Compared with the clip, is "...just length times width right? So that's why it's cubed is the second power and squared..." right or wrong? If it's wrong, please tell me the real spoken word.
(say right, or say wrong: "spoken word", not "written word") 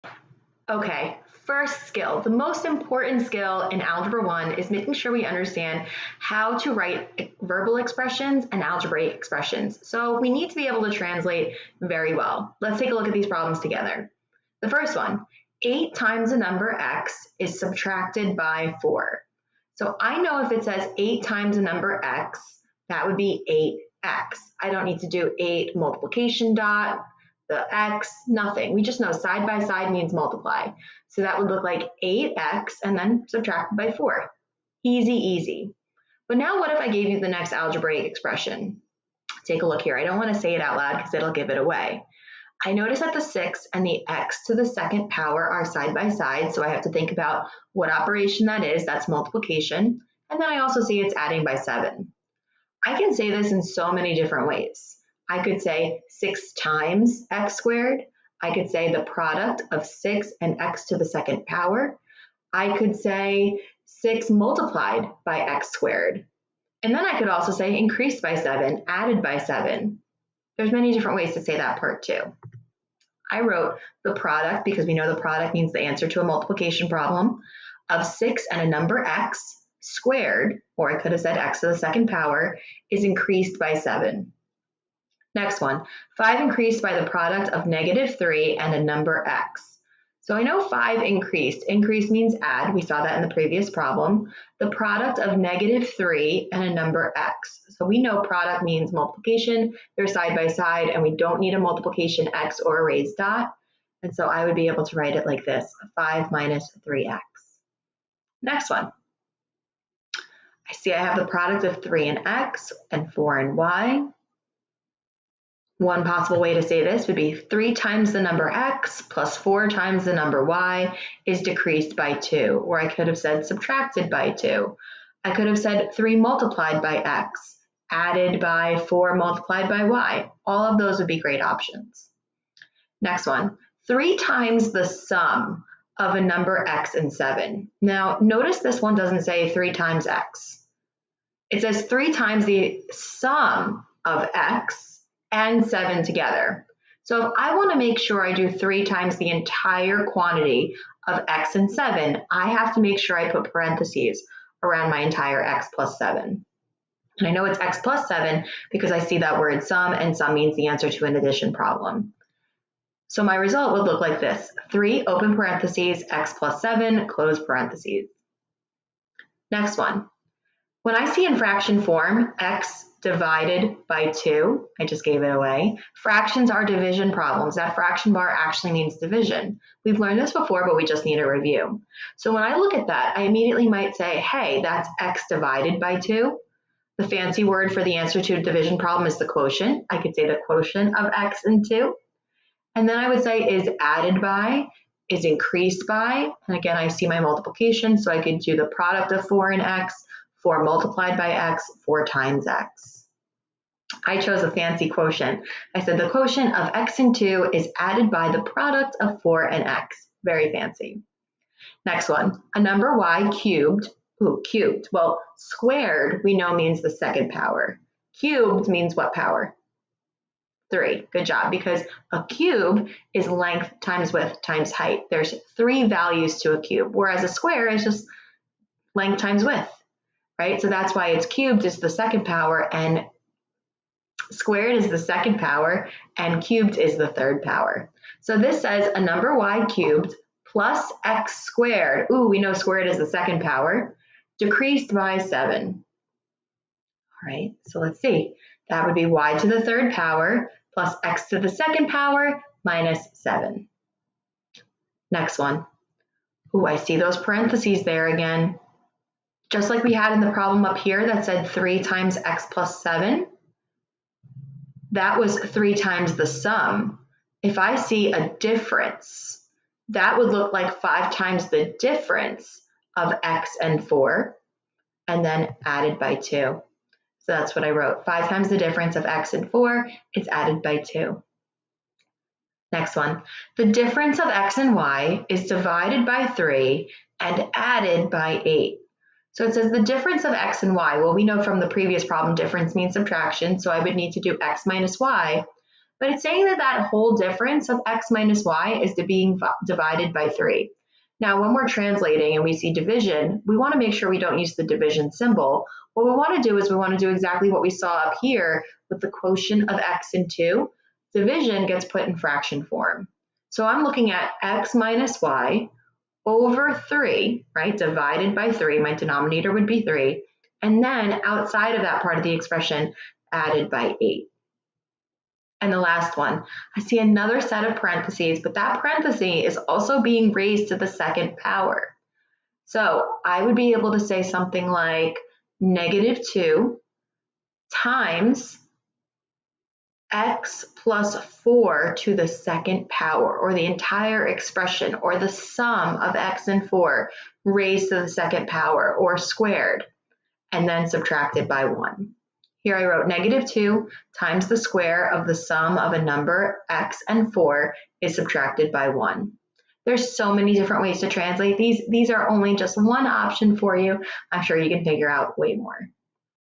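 right.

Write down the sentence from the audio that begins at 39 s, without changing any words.
I don't want to say it out loud because it'll give it away.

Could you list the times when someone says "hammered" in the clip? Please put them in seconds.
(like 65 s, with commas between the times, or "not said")
not said.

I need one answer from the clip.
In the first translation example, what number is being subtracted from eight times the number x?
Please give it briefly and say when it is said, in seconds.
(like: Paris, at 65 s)
4, at 17 s.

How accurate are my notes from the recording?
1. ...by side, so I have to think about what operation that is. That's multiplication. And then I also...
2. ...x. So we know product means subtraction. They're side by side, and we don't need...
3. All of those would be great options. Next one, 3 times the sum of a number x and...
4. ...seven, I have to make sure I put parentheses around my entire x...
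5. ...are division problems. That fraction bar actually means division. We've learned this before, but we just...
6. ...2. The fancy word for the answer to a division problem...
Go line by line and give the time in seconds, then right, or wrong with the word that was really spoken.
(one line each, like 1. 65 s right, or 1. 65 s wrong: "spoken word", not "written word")
1. 45 s right
2. 97 s wrong: "multiplication", not "subtraction"
3. 130 s right
4. 151 s right
5. 176 s right
6. 185 s right.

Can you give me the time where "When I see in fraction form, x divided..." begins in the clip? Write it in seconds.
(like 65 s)
170 s.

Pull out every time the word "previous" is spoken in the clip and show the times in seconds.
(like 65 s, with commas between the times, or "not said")
93 s, 291 s.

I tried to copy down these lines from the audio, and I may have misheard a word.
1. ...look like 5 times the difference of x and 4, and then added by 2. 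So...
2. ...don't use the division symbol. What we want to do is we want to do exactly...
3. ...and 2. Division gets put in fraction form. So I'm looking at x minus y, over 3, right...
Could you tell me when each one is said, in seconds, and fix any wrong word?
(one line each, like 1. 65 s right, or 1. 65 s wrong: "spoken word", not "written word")
1. 270 s right
2. 304 s right
3. 310 s right.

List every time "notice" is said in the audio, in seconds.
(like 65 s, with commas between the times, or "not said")
42 s, 138 s.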